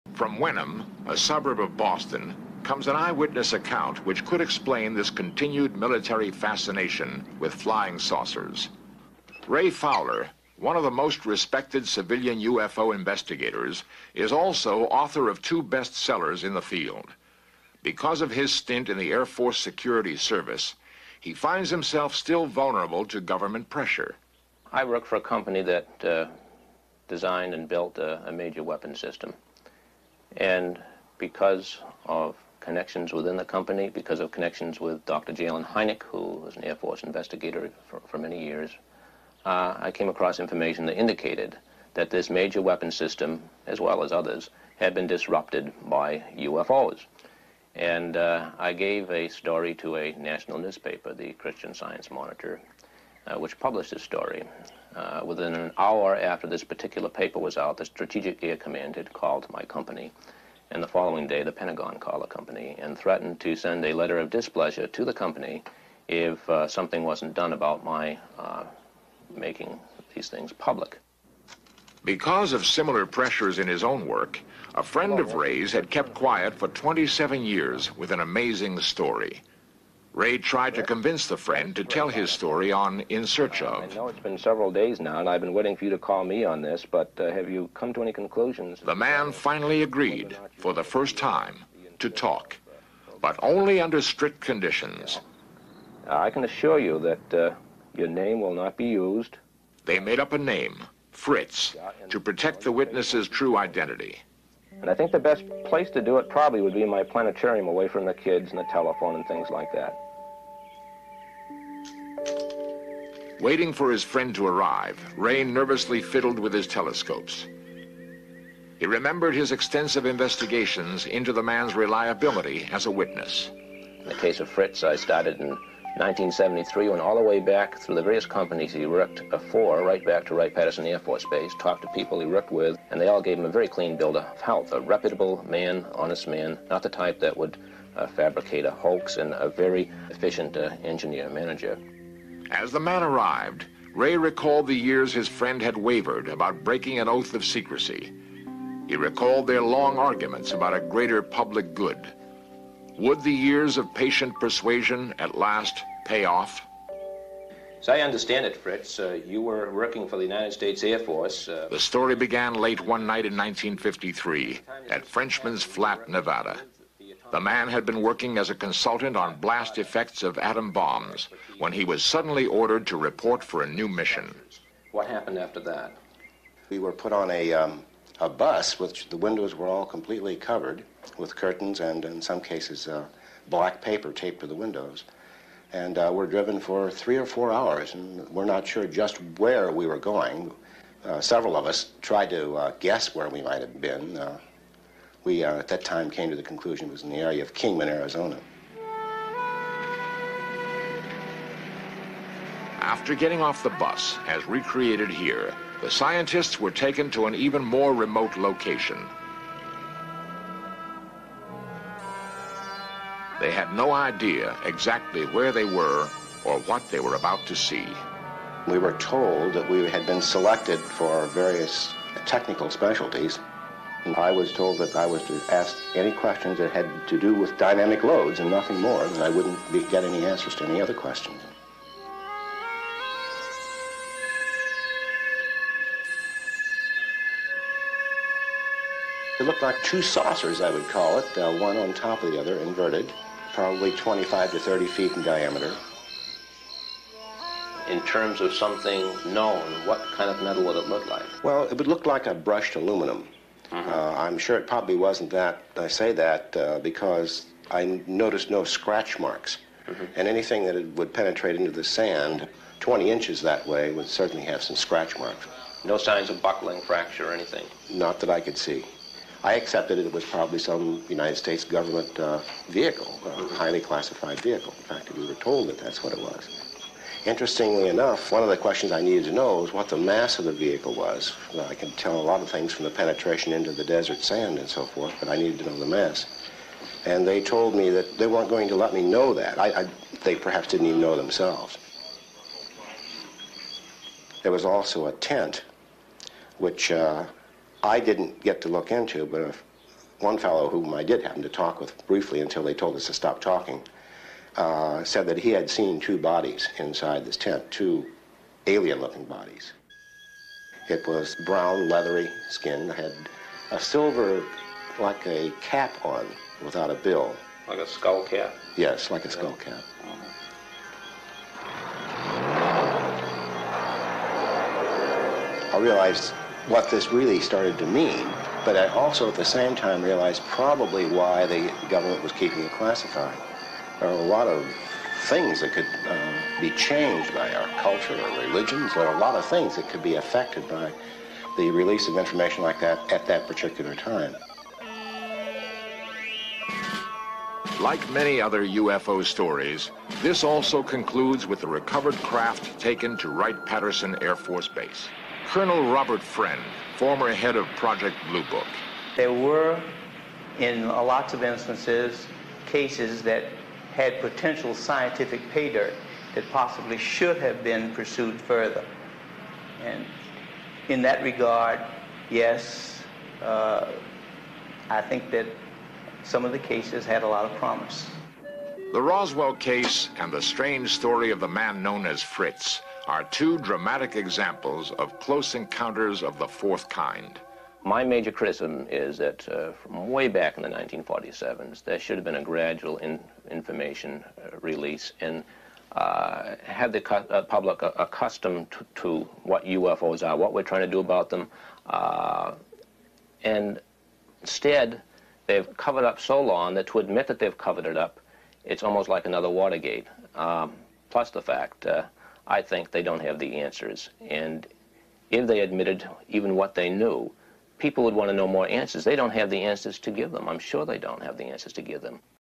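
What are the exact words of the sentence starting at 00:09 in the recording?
Ray Fowler, one of the most respected civilian UFO investigators, is also author of two bestsellers in the field.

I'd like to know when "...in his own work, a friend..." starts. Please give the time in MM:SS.
01:13.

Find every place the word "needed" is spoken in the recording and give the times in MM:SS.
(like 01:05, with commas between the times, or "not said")
04:39, 04:45.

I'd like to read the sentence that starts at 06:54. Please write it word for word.
And if they admitted even what they knew, people would want to know more answers.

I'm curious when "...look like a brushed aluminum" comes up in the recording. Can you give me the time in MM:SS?
04:11.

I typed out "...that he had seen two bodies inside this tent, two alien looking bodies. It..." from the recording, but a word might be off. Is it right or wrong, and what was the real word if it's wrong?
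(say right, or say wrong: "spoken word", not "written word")
right.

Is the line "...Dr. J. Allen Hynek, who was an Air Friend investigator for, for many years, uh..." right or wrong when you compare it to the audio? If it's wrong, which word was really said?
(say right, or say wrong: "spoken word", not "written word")
wrong: "Force", not "Friend".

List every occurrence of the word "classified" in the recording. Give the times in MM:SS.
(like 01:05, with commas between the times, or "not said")
04:33, 05:32.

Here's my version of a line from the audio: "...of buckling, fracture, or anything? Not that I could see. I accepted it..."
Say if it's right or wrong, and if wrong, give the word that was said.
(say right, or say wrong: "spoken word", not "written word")
right.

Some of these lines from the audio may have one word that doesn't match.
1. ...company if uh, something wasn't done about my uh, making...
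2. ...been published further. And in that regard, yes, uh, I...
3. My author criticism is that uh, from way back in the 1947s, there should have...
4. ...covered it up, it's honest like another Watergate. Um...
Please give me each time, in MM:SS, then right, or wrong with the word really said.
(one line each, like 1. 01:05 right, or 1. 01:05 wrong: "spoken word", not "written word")
1. 01:05 right
2. 06:07 wrong: "pursued", not "published"
3. 06:27 wrong: "major", not "author"
4. 06:47 wrong: "almost", not "honest".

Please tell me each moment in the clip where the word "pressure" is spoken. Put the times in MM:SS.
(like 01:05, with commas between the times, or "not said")
00:23, 01:13.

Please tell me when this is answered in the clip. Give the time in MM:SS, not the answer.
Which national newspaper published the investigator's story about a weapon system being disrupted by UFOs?
00:51.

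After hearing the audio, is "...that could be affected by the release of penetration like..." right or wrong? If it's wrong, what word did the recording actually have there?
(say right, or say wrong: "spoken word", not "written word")
wrong: "information", not "penetration".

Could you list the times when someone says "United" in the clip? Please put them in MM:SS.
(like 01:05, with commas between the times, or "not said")
02:40, 04:31.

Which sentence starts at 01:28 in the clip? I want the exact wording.
The man finally agreed, for the first time, to talk, but only under strict conditions.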